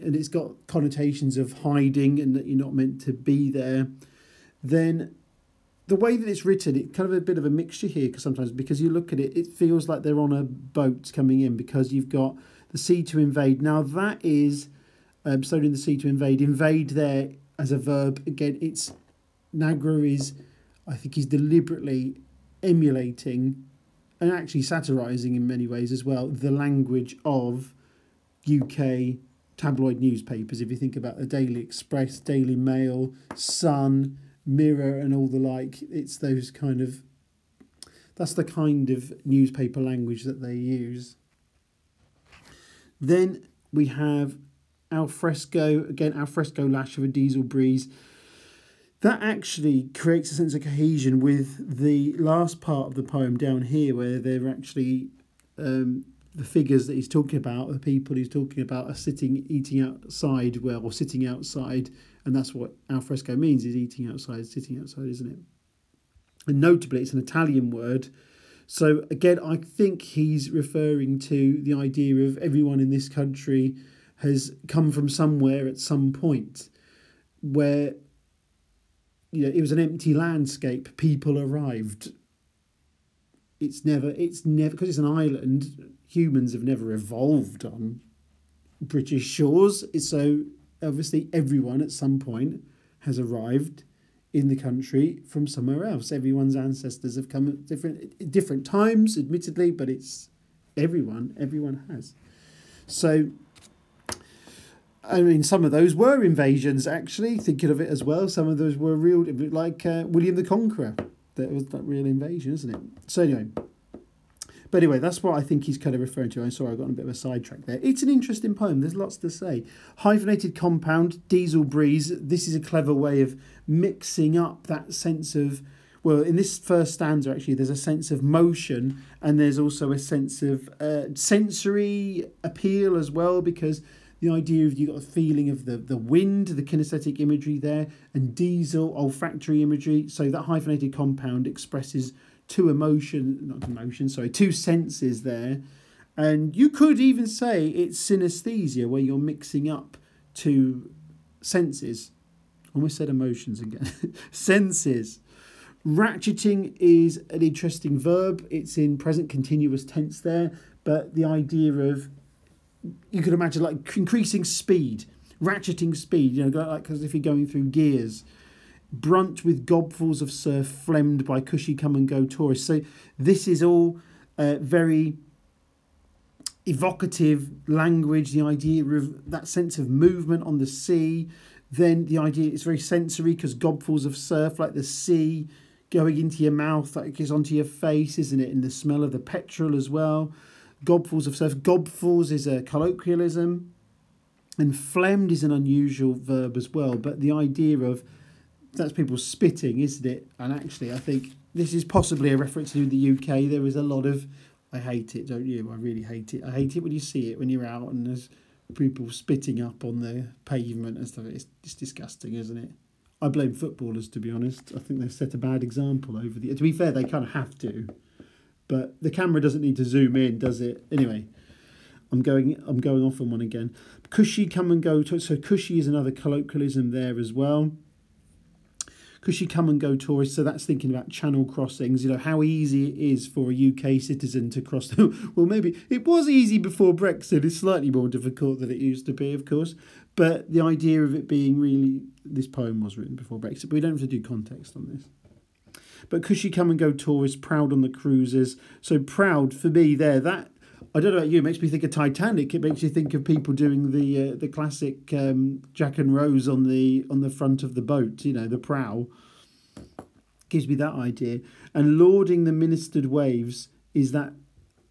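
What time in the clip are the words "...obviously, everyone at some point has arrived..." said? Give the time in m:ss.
1:30.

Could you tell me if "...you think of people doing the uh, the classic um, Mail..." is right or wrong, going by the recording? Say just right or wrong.
wrong.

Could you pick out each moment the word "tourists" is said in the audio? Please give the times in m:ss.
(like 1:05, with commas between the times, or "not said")
2:52, 3:49, 4:06.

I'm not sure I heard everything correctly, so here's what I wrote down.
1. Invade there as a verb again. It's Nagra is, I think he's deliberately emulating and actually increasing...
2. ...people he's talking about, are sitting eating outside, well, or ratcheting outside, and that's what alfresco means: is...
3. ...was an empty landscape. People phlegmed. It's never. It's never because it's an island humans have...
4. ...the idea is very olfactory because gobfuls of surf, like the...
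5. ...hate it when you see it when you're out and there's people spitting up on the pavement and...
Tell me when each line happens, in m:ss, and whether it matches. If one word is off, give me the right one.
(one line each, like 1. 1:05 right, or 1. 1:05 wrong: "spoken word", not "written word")
1. 0:16 wrong: "satirising", not "increasing"
2. 0:57 wrong: "sitting", not "ratcheting"
3. 1:19 wrong: "arrived", not "phlegmed"
4. 3:02 wrong: "sensory", not "olfactory"
5. 3:26 right.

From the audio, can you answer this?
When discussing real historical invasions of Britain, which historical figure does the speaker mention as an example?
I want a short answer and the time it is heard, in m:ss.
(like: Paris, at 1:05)
William the Conqueror, at 1:50.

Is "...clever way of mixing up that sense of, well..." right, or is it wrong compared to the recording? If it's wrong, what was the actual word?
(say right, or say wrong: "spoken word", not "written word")
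right.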